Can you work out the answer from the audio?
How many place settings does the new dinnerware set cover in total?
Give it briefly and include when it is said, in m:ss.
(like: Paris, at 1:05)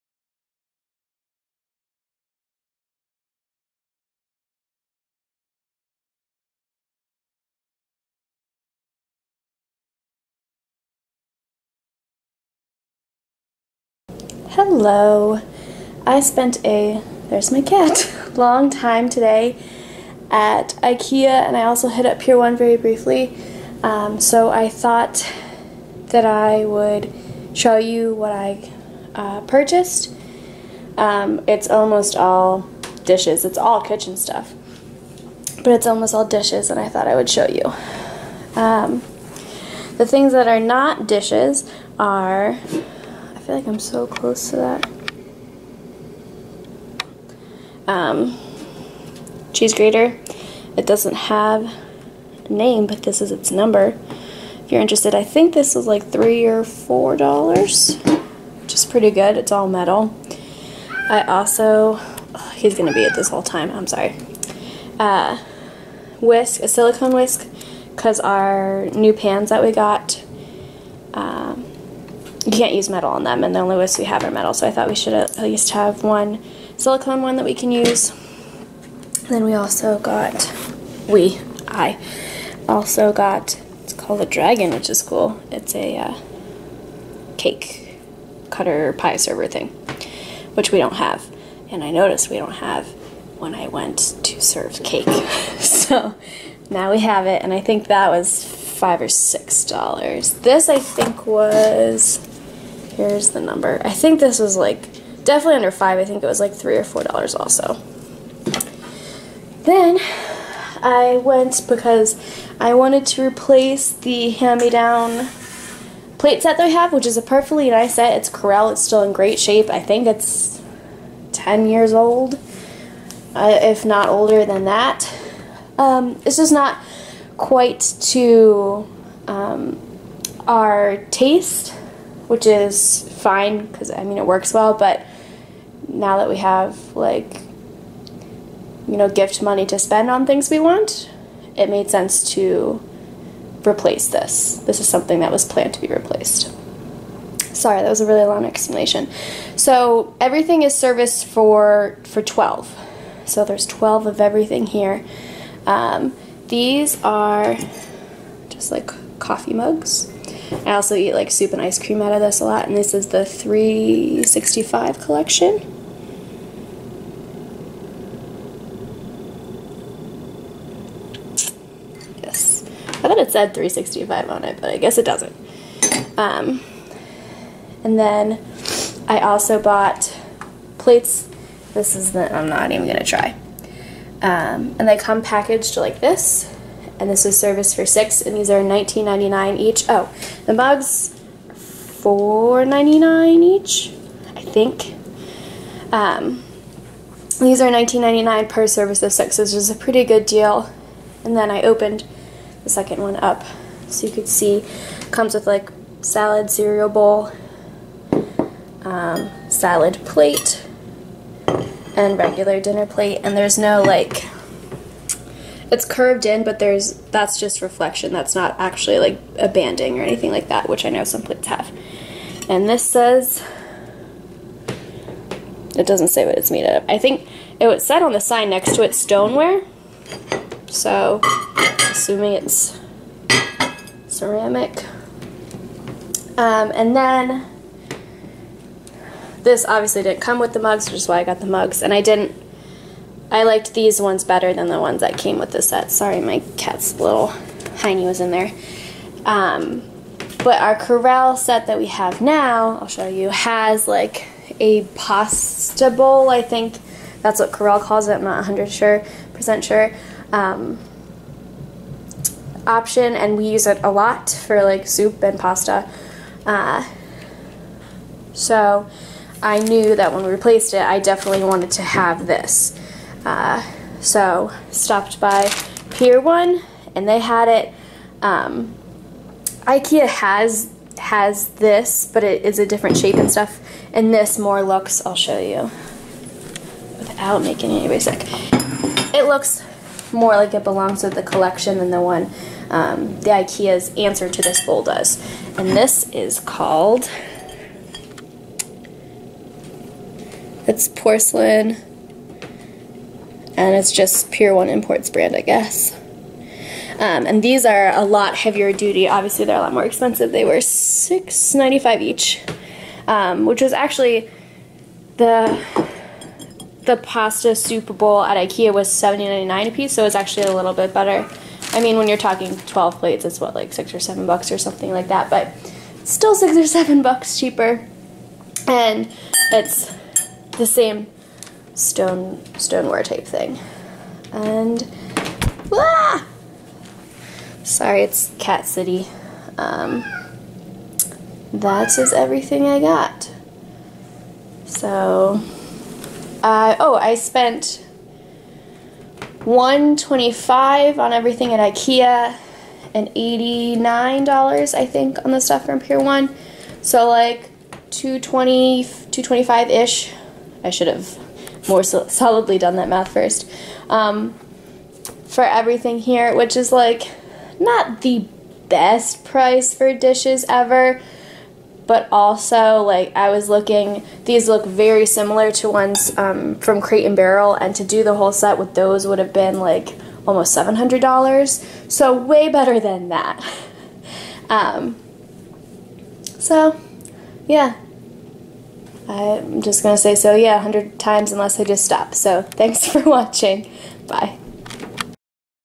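12, at 2:30.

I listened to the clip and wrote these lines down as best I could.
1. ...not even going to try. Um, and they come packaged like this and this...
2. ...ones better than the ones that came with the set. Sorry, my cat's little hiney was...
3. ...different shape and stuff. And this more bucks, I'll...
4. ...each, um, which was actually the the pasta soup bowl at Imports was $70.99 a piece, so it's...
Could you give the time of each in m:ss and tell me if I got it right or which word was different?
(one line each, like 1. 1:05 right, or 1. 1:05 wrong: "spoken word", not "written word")
1. 3:02 right
2. 4:04 right
3. 4:42 wrong: "looks", not "bucks"
4. 5:12 wrong: "IKEA", not "Imports".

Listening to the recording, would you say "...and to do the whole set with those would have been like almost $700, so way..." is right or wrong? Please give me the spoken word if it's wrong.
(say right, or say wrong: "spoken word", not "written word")
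right.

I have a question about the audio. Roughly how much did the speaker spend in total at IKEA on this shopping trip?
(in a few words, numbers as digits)
125.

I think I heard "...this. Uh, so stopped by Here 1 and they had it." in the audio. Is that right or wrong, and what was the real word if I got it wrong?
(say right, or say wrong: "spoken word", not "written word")
wrong: "Pier", not "Here".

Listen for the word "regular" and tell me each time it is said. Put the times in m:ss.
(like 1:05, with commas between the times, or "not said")
3:32.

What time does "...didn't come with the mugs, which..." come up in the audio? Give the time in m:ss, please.
4:00.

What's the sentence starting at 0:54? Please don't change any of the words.
If you're interested, I think this was like three or four dollars, which is pretty good.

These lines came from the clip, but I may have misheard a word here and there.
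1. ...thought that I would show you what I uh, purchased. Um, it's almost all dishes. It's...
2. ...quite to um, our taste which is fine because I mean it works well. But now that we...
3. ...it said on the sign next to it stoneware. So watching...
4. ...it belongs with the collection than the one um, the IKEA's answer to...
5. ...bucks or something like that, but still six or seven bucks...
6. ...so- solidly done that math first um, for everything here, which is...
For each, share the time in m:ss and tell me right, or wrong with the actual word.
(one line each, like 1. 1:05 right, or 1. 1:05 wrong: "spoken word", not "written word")
1. 0:24 right
2. 2:07 right
3. 3:47 wrong: "assuming", not "watching"
4. 4:50 right
5. 5:24 right
6. 6:01 right.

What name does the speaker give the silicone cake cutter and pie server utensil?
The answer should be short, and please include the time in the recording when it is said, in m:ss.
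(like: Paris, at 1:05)
dragon, at 1:24.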